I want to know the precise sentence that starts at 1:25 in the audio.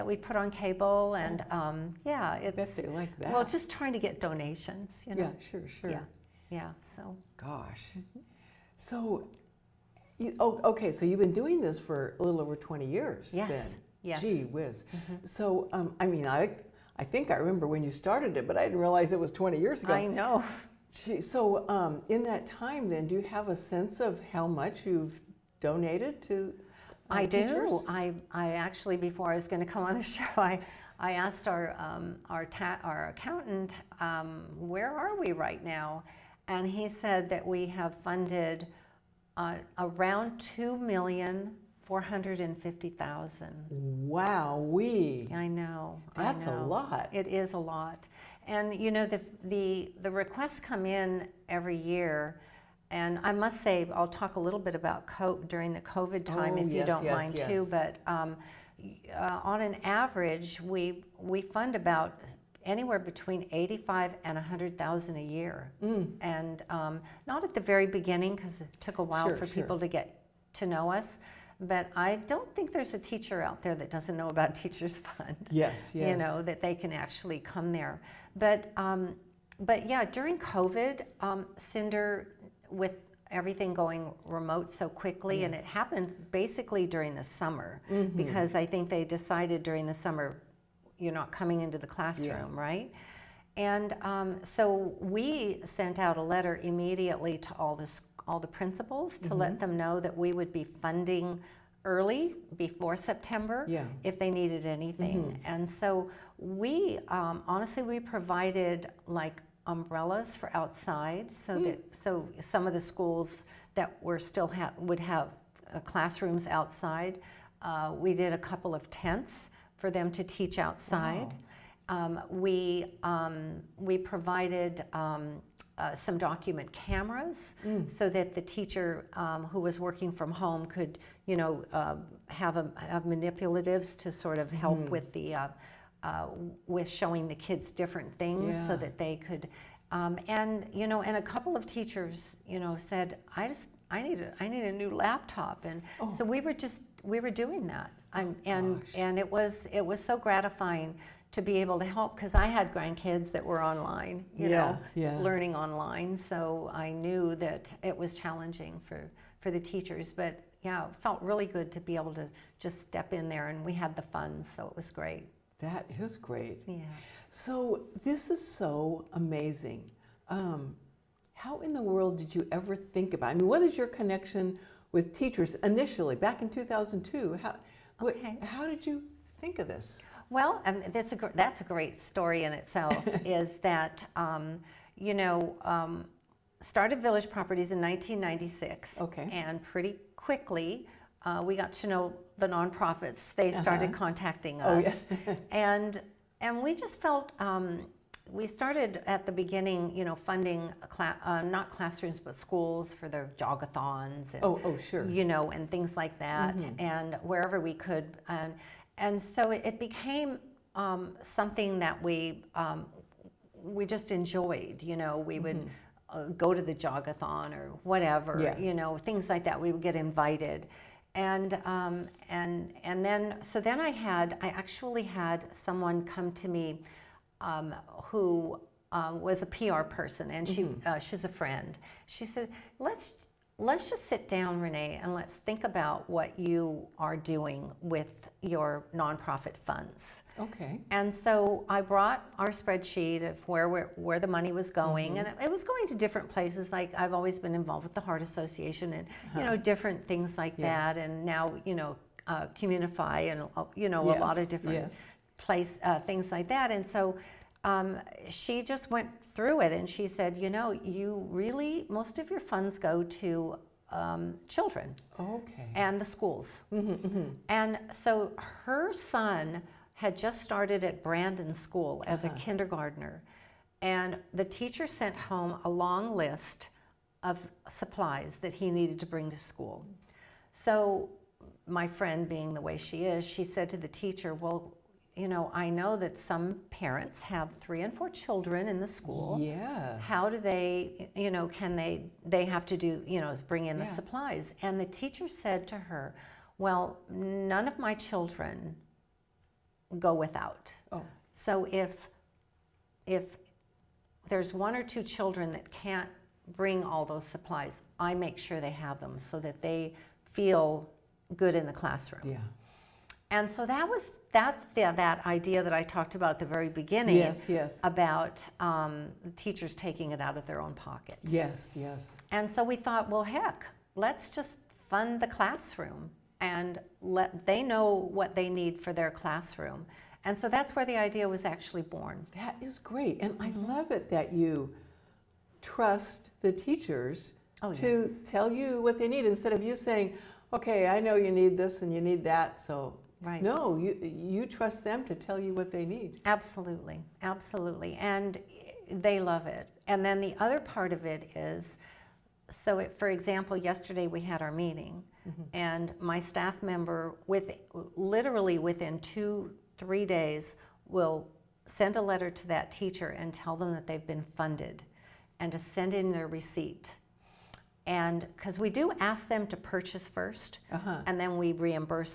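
and it happened basically during the summer mm-hmm.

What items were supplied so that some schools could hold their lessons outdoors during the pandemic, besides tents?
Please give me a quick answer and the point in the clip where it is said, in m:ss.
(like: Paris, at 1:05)
Umbrellas, at 1:49.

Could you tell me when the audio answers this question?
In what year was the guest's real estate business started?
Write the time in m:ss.
3:07.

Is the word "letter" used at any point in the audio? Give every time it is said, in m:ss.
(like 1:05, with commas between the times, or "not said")
1:36, 6:02.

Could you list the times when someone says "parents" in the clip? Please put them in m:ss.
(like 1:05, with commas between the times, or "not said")
4:46.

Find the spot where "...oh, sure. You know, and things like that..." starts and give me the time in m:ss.
3:24.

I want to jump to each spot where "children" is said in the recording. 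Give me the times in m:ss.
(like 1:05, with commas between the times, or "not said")
4:24, 4:48, 4:57, 5:05.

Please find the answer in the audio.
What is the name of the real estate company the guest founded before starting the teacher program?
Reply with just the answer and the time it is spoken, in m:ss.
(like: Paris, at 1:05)
Village Properties, at 3:07.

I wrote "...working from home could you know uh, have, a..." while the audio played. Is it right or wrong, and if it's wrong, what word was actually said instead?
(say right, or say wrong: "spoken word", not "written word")
right.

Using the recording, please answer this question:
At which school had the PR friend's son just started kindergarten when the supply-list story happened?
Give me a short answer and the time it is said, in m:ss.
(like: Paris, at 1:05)
Brandon School, at 4:31.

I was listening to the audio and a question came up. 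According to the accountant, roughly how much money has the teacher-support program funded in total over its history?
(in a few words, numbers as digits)
$2,450,000.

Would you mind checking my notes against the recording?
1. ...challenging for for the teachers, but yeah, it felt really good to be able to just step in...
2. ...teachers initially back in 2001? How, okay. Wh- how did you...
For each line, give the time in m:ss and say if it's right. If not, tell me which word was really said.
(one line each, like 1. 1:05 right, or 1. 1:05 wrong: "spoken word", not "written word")
1. 2:38 right
2. 2:55 wrong: "2002", not "2001".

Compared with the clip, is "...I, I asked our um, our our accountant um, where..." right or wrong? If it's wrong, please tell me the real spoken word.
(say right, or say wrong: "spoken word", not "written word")
right.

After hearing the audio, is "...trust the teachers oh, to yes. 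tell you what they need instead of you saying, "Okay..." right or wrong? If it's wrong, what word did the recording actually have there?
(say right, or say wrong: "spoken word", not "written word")
right.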